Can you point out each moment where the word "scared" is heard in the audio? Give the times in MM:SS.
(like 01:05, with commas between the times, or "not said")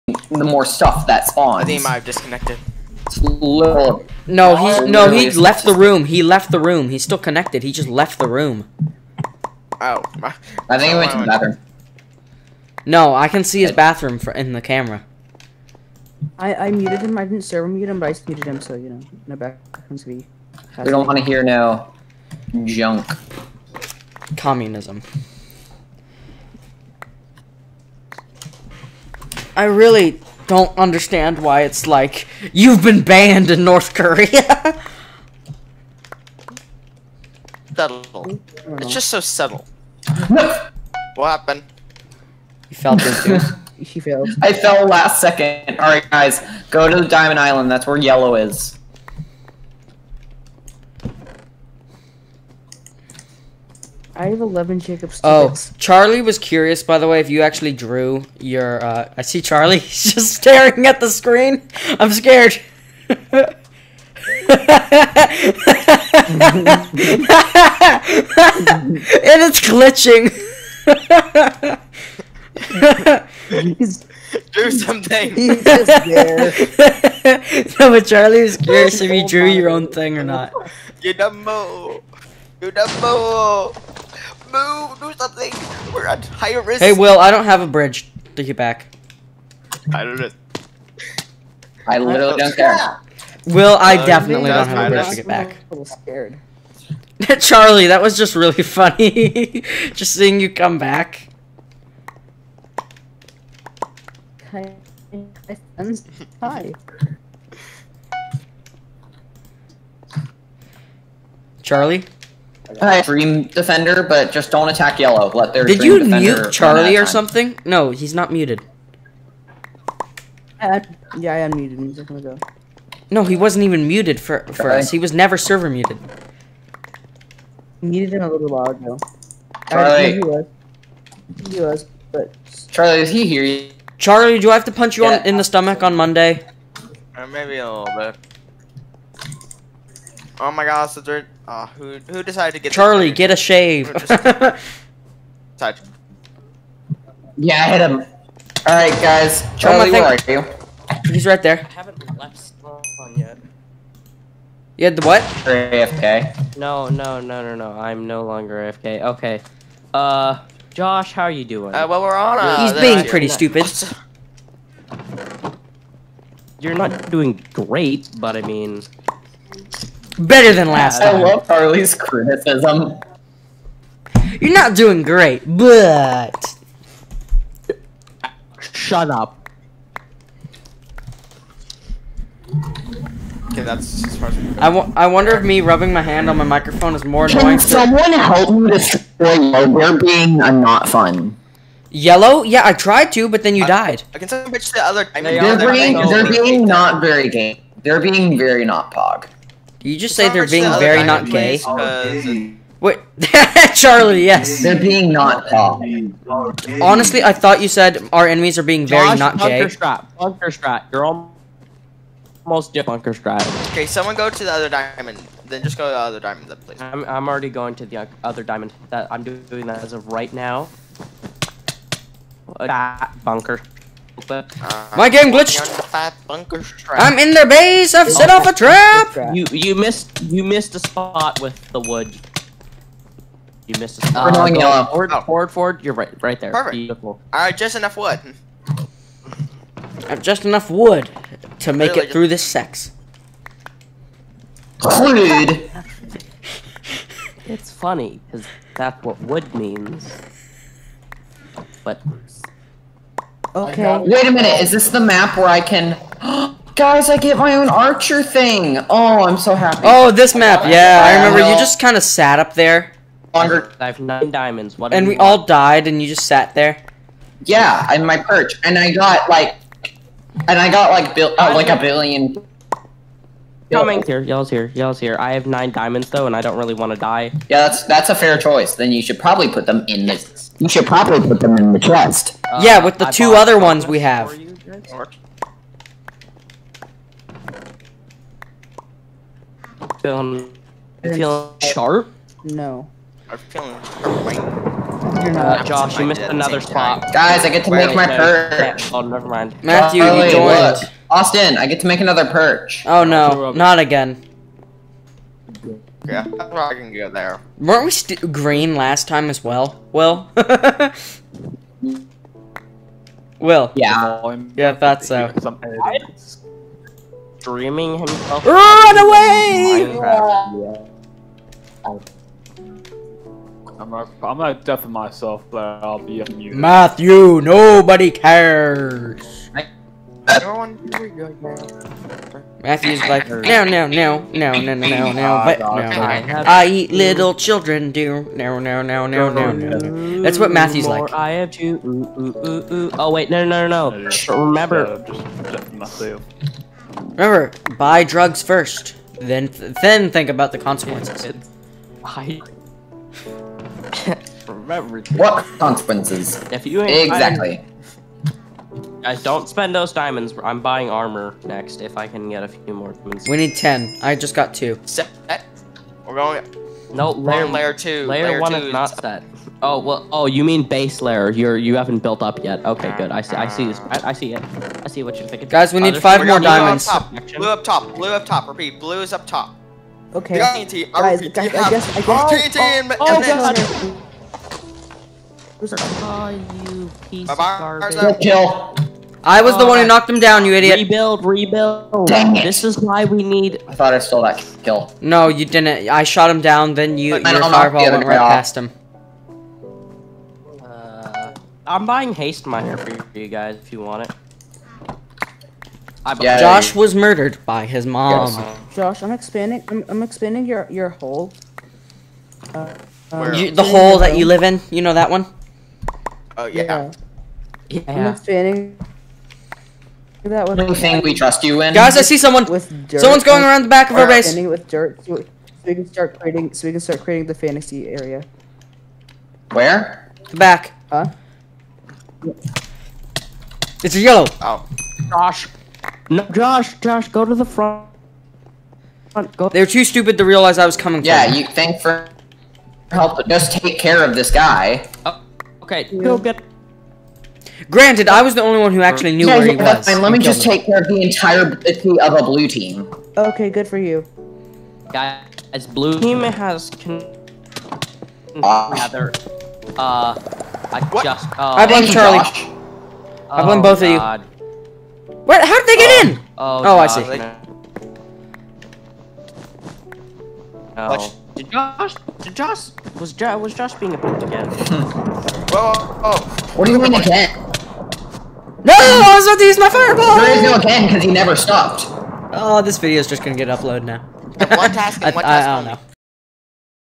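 01:02, 01:35.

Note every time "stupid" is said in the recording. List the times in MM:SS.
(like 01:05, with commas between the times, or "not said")
02:43, 07:19.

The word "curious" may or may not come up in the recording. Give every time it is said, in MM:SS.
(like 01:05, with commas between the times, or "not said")
00:56, 01:18.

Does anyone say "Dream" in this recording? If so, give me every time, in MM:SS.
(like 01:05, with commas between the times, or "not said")
01:53.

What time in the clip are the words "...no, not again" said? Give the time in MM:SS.
05:03.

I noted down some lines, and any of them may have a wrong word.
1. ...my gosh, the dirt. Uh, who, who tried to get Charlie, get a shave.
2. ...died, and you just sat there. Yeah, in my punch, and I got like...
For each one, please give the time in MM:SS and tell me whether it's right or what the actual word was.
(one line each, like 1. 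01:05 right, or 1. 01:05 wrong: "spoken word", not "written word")
1. 02:20 wrong: "decided", not "tried"
2. 04:25 wrong: "perch", not "punch".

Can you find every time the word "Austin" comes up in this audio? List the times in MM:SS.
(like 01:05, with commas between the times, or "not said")
05:01.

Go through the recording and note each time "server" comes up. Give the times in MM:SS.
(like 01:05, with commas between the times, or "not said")
00:17, 02:05.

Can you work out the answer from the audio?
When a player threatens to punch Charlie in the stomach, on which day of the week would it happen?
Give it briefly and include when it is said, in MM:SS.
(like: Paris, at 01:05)
Monday, at 02:15.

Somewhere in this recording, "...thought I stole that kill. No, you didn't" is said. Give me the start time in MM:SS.
06:33.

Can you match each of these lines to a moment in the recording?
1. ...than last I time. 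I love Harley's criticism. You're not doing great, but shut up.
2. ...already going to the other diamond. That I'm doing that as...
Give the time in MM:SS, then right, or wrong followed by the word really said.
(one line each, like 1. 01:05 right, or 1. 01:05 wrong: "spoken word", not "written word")
1. 02:50 right
2. 03:37 right.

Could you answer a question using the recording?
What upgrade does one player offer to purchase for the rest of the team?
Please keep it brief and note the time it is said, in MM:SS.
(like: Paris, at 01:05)
Haste Miner, at 06:42.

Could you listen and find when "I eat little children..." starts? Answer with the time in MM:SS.
05:36.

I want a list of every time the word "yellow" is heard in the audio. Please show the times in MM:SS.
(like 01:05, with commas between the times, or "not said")
00:47, 01:54, 03:11, 03:54, 07:13.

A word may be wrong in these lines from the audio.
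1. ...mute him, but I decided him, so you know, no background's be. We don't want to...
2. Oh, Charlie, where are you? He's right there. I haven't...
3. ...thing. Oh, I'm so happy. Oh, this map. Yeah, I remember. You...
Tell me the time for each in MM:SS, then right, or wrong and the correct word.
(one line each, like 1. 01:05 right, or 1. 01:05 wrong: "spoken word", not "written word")
1. 00:17 wrong: "muted", not "decided"
2. 02:29 right
3. 04:18 right.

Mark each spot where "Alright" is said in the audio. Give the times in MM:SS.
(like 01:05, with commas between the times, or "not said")
00:45, 02:28.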